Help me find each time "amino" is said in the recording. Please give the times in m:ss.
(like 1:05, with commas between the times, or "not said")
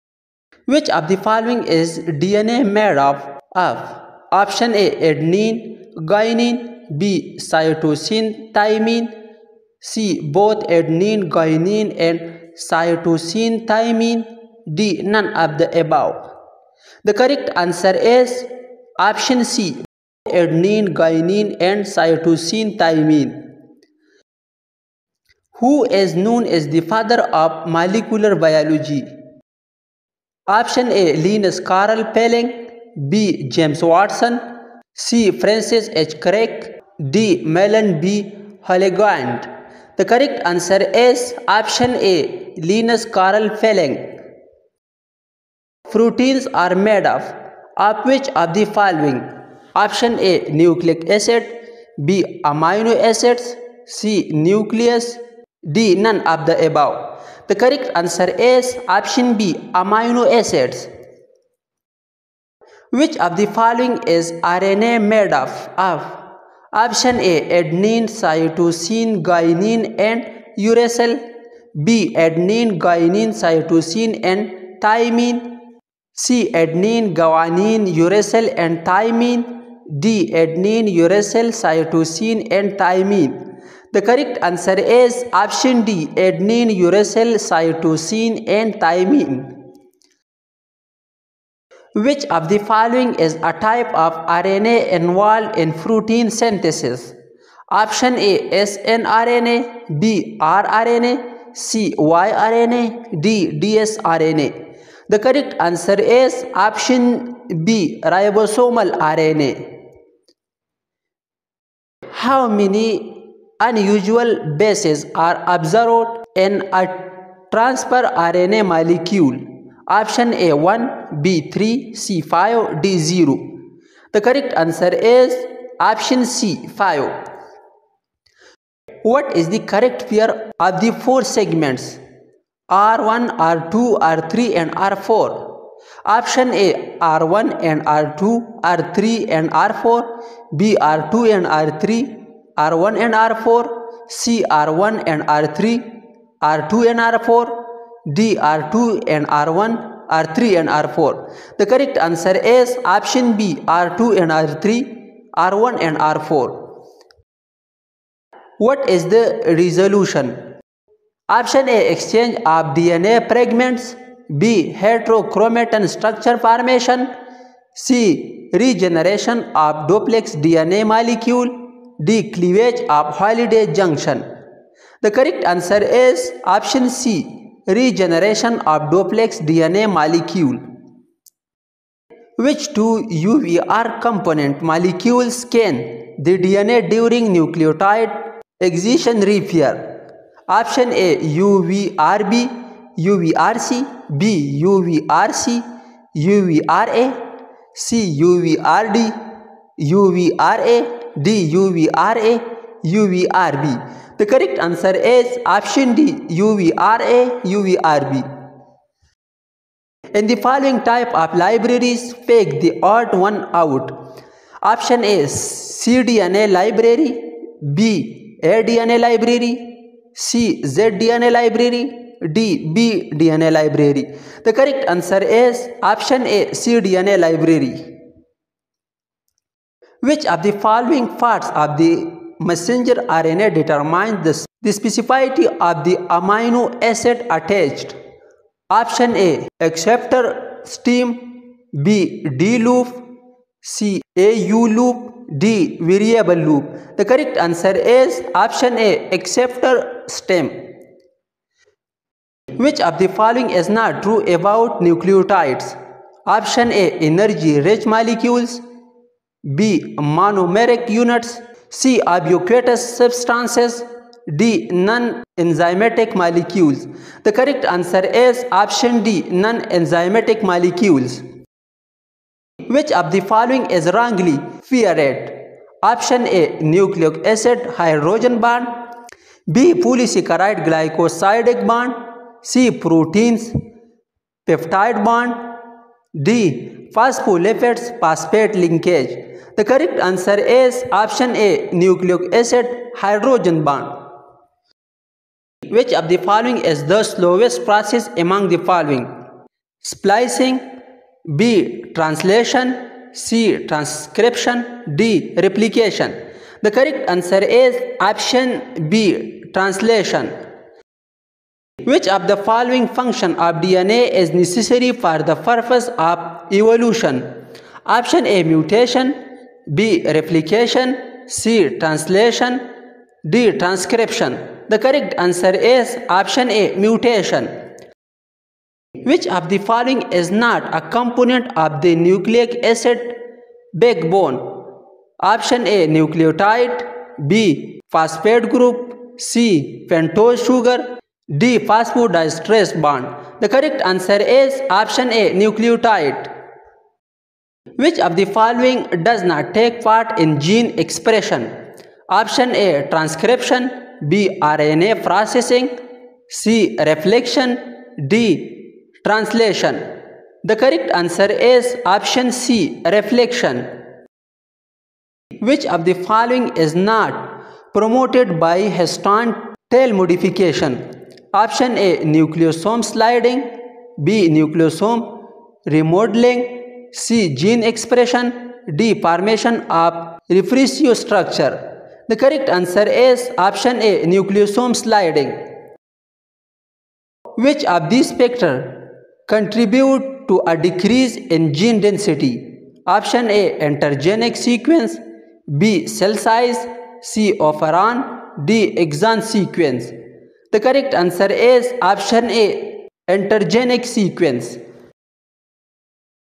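0:52, 0:59, 3:56.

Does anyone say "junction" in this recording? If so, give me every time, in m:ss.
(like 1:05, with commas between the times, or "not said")
2:53.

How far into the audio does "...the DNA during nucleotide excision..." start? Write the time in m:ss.
3:06.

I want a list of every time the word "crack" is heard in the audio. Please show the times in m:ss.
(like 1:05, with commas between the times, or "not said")
not said.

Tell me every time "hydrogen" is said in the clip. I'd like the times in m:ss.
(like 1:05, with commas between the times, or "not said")
4:37, 4:52.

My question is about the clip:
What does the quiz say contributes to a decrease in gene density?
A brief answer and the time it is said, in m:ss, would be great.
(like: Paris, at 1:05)
Intergenic sequence, at 6:43.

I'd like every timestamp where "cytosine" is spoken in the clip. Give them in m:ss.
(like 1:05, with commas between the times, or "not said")
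0:07, 0:12, 0:21, 1:08, 1:13, 1:21, 1:27.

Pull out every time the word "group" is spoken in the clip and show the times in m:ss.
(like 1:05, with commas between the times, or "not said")
5:38.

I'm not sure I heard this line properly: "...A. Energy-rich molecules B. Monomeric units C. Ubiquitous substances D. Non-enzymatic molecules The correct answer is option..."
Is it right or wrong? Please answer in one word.
right.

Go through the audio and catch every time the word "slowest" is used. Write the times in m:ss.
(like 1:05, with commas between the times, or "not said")
4:57.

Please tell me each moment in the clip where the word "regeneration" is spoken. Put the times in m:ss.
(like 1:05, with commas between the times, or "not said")
2:48, 2:57.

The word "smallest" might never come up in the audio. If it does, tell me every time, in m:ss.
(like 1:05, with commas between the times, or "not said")
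not said.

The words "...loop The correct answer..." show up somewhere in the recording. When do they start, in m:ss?
4:06.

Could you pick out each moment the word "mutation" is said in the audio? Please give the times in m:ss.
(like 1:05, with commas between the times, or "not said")
5:18, 5:26.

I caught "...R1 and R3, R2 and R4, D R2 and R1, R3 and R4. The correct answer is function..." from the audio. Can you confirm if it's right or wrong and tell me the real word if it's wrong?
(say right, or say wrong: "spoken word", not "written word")
wrong: "option", not "function".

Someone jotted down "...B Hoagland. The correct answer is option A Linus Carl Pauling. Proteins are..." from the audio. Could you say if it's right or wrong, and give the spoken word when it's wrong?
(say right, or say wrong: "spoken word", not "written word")
right.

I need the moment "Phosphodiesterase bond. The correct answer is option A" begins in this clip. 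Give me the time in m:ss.
5:41.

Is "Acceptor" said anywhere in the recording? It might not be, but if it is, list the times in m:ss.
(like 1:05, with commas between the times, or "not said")
3:59, 4:09.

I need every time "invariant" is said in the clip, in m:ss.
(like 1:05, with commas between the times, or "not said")
not said.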